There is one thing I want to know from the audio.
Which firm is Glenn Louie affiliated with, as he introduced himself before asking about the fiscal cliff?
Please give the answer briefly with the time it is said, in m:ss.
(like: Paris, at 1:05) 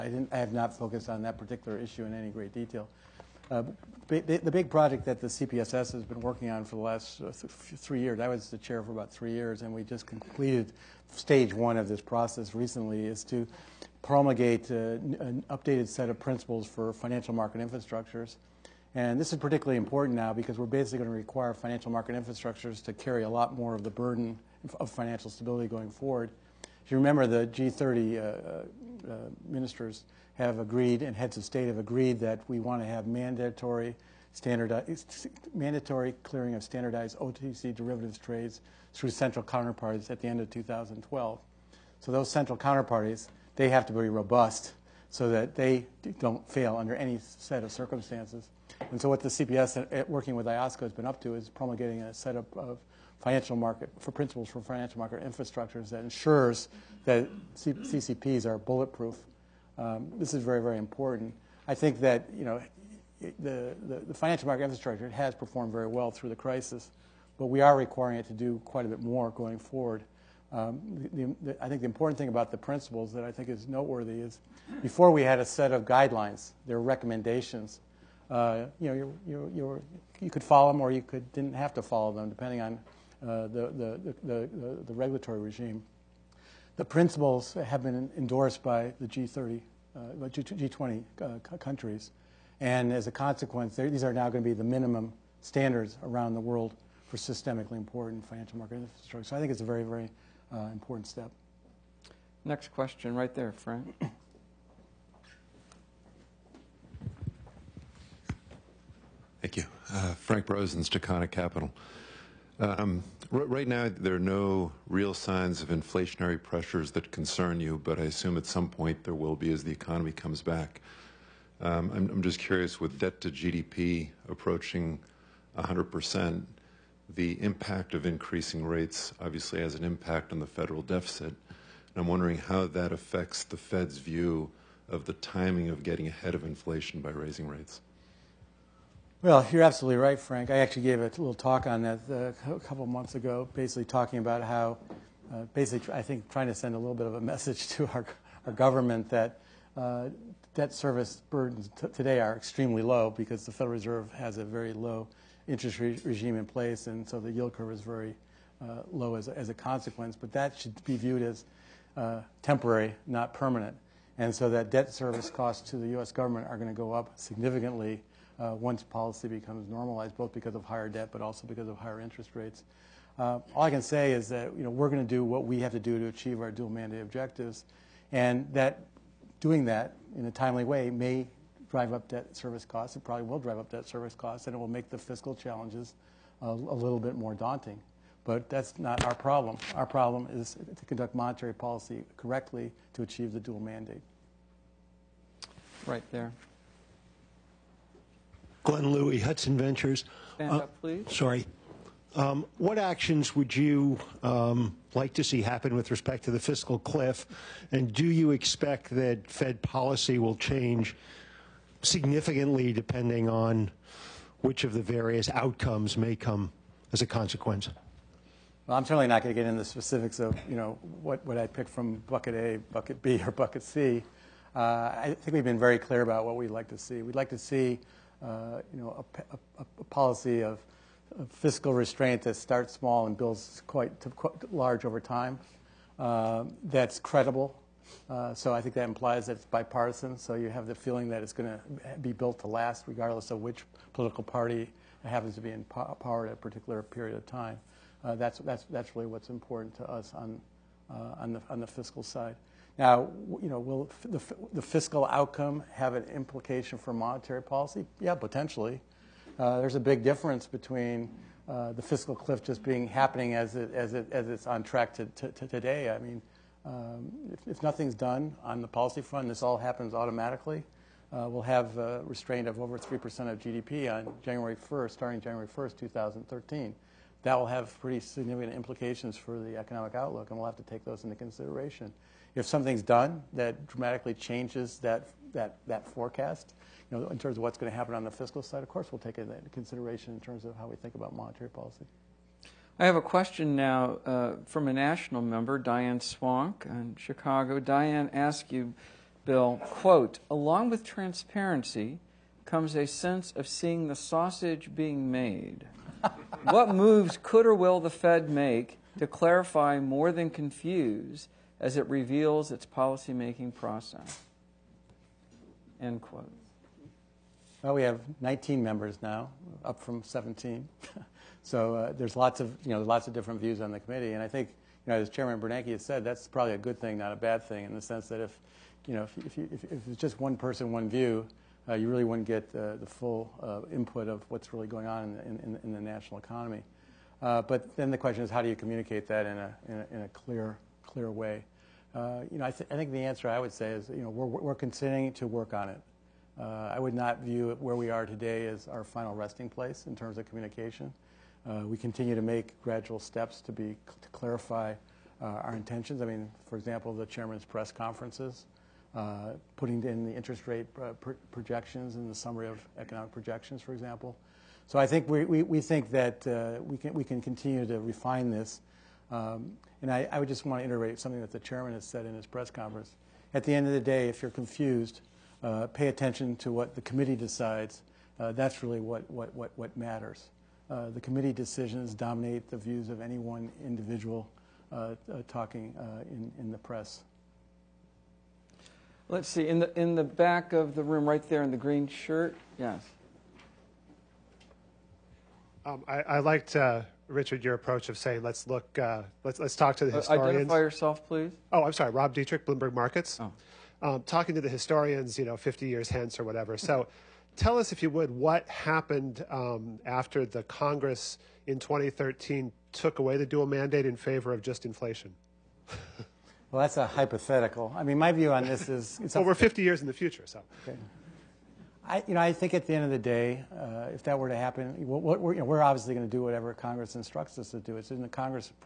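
Hudson Ventures, at 3:19.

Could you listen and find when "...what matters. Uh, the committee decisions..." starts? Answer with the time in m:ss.
6:19.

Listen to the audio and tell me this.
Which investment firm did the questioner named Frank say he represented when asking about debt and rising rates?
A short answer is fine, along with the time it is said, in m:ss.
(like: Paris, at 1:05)
Stacana Capital, at 1:50.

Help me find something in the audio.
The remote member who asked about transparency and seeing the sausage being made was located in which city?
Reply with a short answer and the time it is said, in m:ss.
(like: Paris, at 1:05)
Chicago, at 4:56.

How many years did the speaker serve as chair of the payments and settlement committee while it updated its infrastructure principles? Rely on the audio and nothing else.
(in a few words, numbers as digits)
3.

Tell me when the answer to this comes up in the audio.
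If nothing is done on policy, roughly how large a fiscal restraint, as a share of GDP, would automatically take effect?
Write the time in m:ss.
4:32.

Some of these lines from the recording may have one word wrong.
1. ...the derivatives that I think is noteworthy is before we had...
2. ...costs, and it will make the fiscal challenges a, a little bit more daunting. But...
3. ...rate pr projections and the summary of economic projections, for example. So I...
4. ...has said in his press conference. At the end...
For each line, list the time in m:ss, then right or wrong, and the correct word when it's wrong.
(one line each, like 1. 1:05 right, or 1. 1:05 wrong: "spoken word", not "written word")
1. 1:12 wrong: "principles", not "derivatives"
2. 3:04 right
3. 6:00 right
4. 6:11 right.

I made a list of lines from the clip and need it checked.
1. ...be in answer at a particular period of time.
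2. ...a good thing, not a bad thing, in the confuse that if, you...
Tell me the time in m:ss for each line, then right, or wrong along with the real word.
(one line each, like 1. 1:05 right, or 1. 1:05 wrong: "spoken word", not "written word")
1. 4:05 wrong: "power", not "answer"
2. 5:26 wrong: "sense", not "confuse".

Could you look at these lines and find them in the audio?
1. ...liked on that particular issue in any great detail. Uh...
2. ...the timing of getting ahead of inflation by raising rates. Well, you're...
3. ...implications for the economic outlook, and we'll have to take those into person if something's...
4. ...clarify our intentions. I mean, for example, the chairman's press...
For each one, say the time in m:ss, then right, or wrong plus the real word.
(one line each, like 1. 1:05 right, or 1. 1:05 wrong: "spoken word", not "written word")
1. 0:00 wrong: "focused", not "liked"
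2. 2:15 right
3. 4:38 wrong: "consideration", not "person"
4. 5:54 right.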